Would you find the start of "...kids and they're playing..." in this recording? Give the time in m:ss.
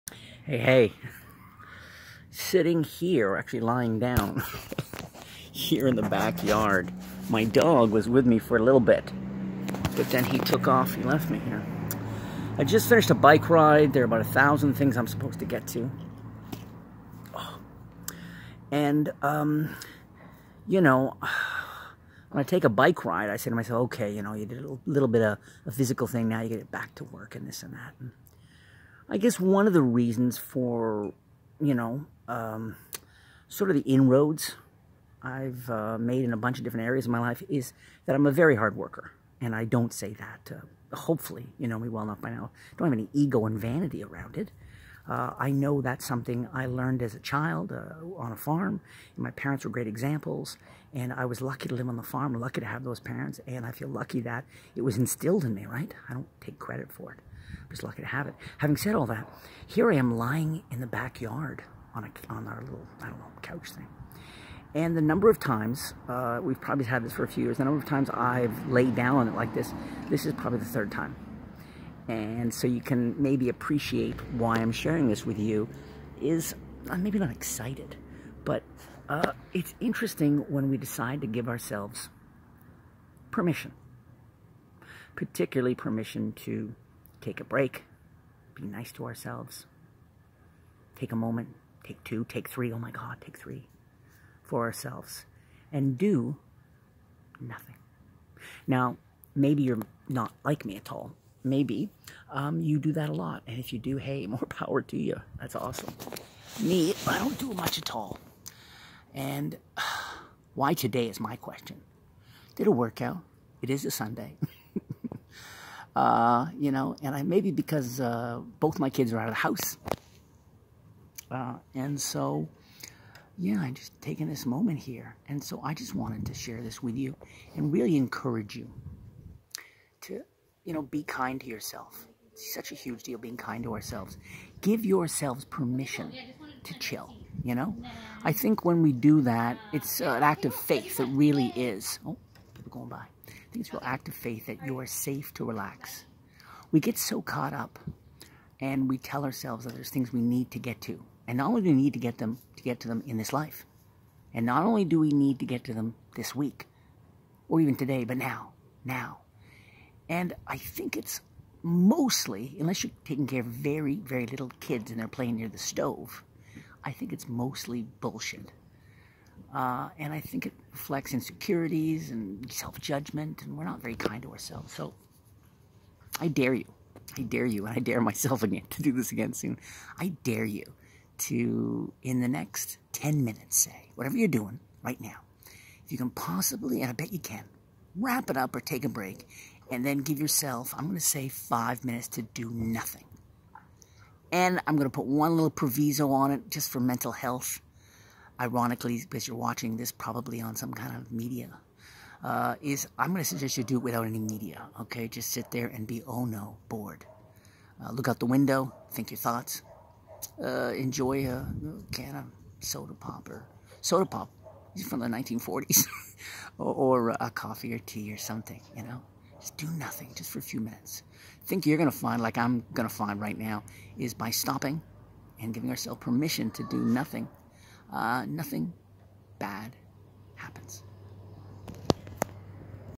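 2:44.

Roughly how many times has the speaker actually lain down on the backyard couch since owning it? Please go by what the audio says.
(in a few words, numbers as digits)
3.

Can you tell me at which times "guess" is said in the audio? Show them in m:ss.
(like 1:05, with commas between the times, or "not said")
0:29.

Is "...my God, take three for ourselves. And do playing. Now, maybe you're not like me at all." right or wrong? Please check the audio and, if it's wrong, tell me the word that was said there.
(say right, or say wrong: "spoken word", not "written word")
wrong: "nothing", not "playing".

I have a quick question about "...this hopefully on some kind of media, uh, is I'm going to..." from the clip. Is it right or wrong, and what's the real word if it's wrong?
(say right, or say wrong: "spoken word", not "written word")
wrong: "probably", not "hopefully".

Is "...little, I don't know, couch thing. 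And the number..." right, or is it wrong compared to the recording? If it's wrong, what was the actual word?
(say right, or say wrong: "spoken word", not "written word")
right.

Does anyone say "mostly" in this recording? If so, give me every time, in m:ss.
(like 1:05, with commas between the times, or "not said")
2:41, 2:47.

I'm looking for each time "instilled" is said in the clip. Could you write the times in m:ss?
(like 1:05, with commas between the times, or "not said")
0:54.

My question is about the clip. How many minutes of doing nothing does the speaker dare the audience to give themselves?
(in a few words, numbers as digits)
5.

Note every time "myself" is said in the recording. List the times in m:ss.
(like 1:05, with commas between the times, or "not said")
0:23, 2:57.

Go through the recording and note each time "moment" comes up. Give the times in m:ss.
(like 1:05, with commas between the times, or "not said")
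1:31, 2:04.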